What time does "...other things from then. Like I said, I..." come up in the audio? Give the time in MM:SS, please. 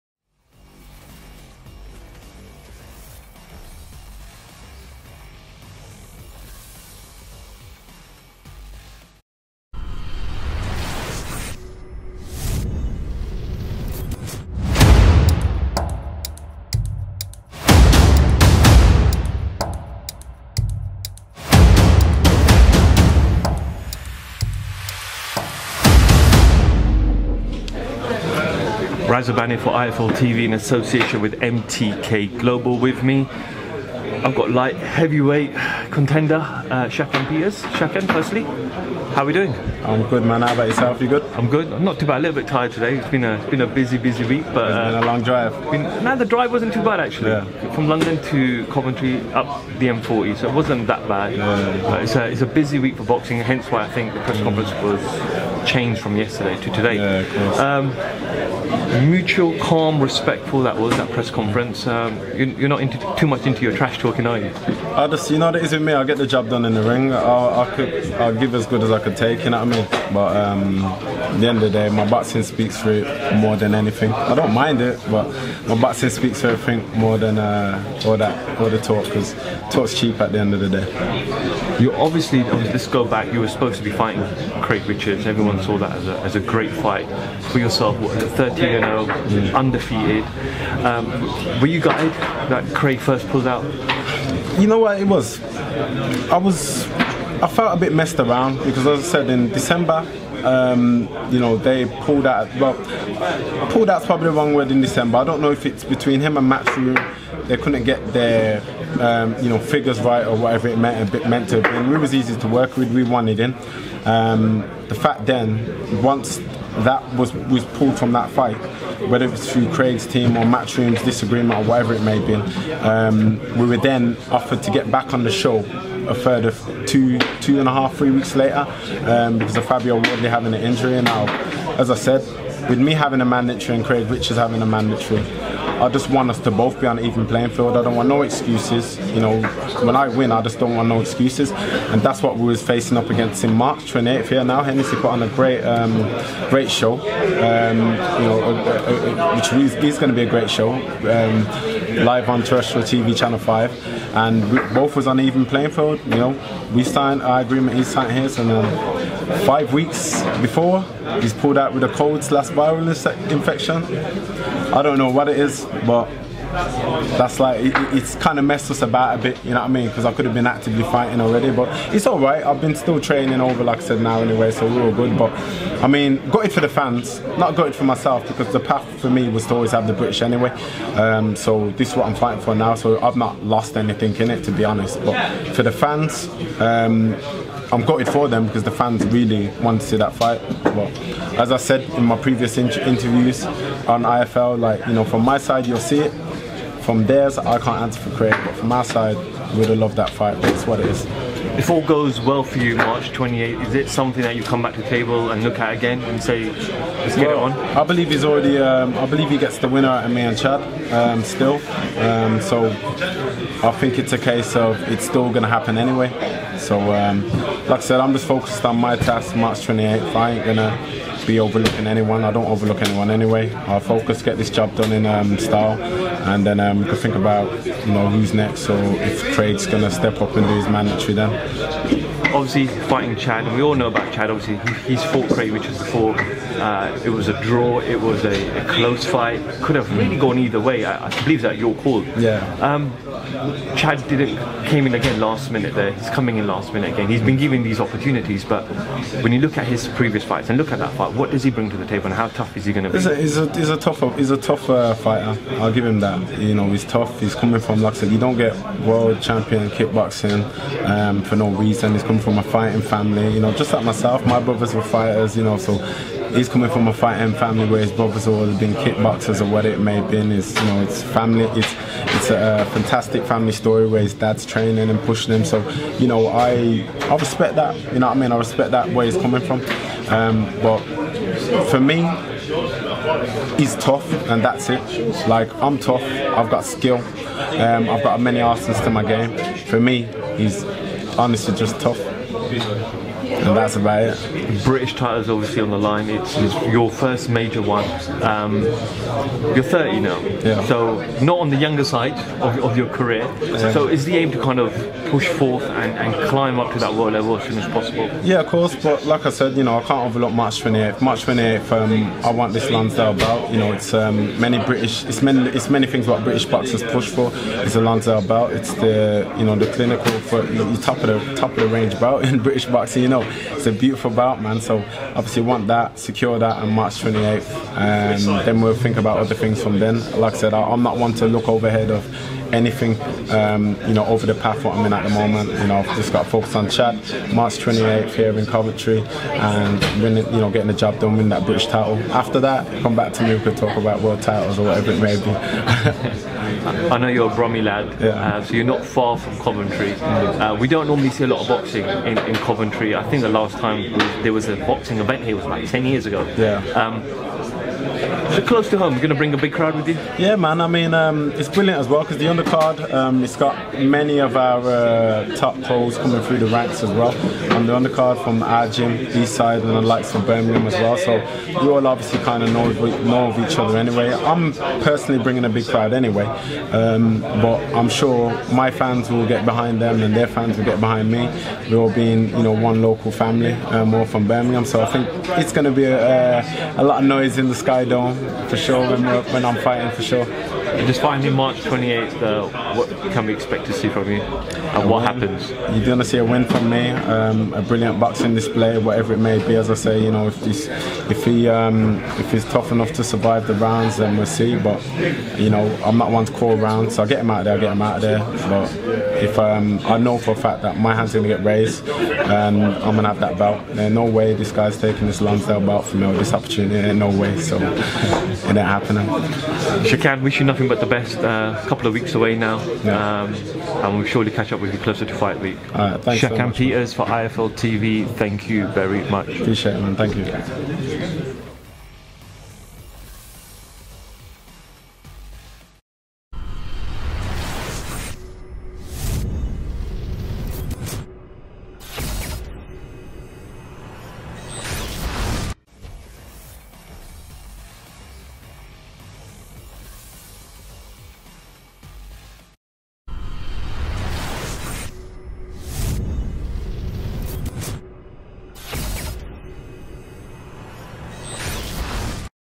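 05:29.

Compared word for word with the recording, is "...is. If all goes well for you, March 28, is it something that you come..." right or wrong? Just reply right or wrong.
right.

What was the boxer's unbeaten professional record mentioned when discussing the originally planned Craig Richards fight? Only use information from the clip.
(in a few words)
13 and 0.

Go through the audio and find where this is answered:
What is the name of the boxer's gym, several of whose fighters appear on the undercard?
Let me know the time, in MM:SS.
06:09.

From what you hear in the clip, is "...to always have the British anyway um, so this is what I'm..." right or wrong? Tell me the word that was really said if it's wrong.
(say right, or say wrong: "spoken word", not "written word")
right.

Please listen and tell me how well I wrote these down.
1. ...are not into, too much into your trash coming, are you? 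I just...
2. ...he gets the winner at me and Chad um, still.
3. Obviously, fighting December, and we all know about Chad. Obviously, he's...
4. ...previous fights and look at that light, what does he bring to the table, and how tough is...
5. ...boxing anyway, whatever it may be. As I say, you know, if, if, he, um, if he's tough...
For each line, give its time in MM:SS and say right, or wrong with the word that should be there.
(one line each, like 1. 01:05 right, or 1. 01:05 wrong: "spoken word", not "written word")
1. 01:02 wrong: "talking", not "coming"
2. 03:29 right
3. 03:52 wrong: "Chad", not "December"
4. 04:09 wrong: "fight", not "light"
5. 06:37 wrong: "display", not "anyway".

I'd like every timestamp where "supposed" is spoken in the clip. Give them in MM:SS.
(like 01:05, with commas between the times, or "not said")
01:23.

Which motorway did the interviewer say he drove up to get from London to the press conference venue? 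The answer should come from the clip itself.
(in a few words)
M40.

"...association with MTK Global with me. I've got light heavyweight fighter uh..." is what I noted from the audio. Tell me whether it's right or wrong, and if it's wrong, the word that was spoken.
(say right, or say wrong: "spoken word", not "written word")
wrong: "contender", not "fighter".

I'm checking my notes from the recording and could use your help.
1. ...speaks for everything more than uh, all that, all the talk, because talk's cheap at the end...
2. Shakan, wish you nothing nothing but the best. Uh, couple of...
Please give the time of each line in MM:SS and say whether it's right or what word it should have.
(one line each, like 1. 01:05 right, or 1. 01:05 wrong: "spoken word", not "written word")
1. 01:16 right
2. 06:59 right.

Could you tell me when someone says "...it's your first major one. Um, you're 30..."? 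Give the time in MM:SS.
04:56.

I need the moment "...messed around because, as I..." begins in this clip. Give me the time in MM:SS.
01:37.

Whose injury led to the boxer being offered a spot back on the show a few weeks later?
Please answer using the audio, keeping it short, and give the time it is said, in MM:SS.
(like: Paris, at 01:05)
Fabio Wardley, at 02:09.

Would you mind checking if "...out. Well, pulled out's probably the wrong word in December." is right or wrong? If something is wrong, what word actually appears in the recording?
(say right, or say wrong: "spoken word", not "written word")
right.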